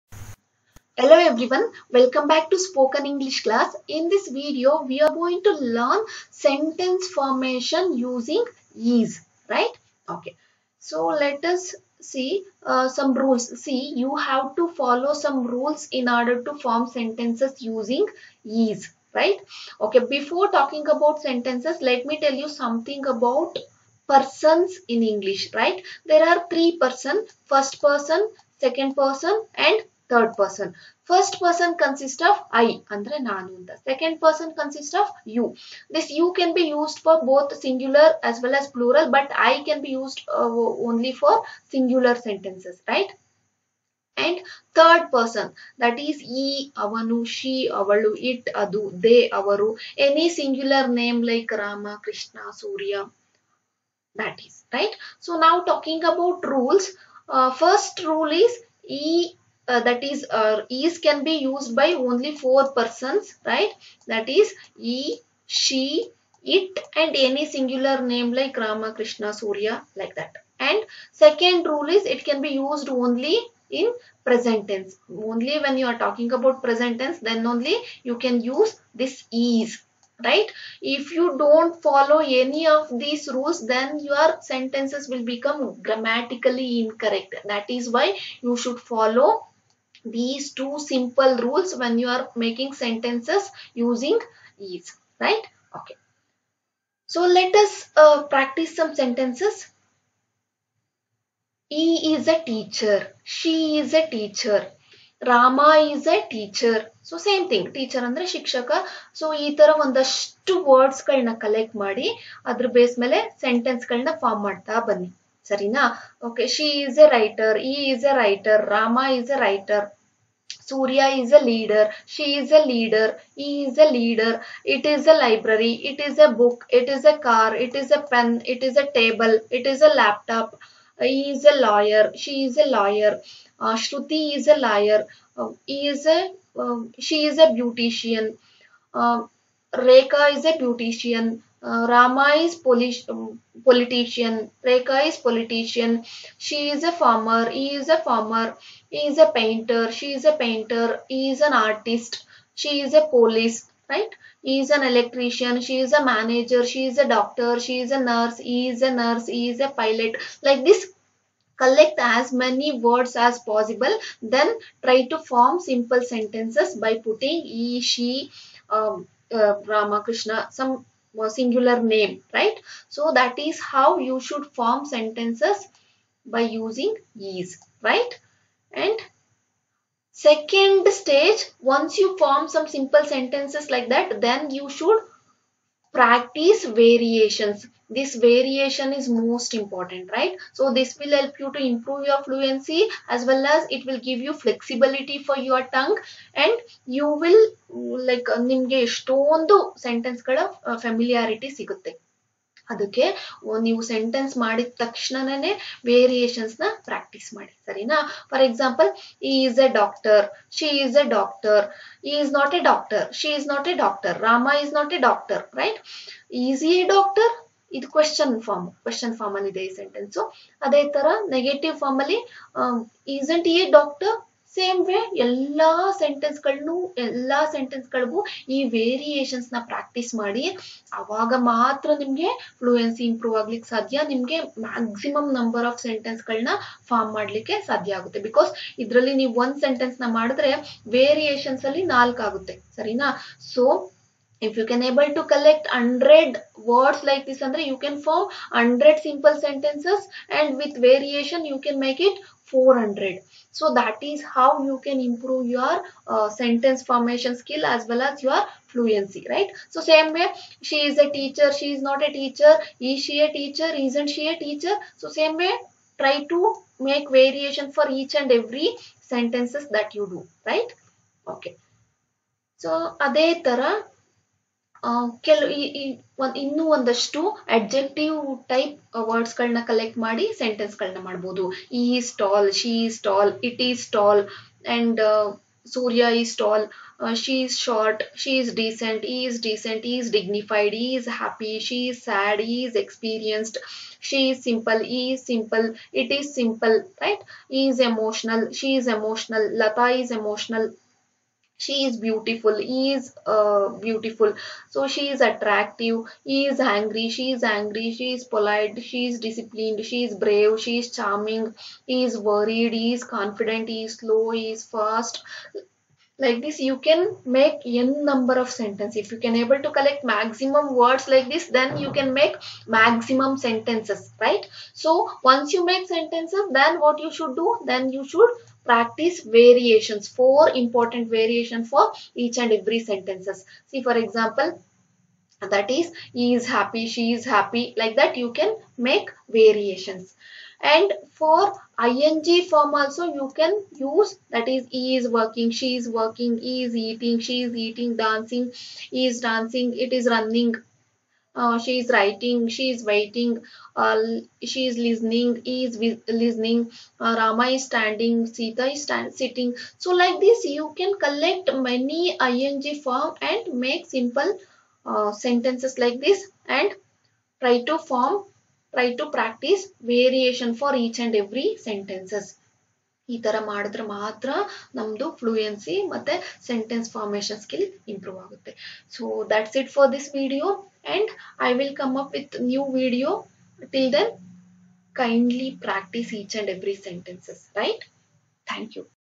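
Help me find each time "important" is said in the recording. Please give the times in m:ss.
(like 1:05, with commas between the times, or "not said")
3:09, 5:30.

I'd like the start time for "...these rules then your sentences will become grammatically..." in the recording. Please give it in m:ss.
1:22.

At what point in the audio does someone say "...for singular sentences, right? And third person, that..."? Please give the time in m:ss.
0:41.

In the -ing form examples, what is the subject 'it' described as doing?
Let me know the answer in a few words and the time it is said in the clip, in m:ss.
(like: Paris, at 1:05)
running, at 5:49.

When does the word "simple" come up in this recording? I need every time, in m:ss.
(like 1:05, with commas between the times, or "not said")
1:30, 2:45, 3:02, 4:09, 6:03.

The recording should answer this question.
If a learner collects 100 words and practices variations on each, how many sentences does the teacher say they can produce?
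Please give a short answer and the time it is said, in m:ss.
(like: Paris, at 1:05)
400, at 4:12.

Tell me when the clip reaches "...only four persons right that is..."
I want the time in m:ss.
1:01.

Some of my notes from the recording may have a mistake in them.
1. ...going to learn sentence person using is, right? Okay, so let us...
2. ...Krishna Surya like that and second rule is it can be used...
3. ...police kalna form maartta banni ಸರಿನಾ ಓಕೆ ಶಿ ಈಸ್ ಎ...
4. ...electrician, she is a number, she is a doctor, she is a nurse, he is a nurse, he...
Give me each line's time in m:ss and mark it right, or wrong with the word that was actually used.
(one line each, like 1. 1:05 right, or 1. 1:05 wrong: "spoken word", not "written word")
1. 0:05 wrong: "formation", not "person"
2. 1:08 right
3. 1:53 wrong: "sentence", not "police"
4. 2:34 wrong: "manager", not "number".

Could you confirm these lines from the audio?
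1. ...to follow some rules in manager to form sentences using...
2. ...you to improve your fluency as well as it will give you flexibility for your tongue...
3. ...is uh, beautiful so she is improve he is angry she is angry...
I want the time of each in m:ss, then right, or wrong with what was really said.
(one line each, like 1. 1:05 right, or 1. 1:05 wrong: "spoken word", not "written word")
1. 0:14 wrong: "order", not "manager"
2. 3:11 right
3. 5:02 wrong: "attractive", not "improve".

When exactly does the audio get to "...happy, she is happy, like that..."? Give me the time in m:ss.
5:36.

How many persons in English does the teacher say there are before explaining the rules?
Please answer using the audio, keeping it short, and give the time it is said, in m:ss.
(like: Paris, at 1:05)
3, at 0:26.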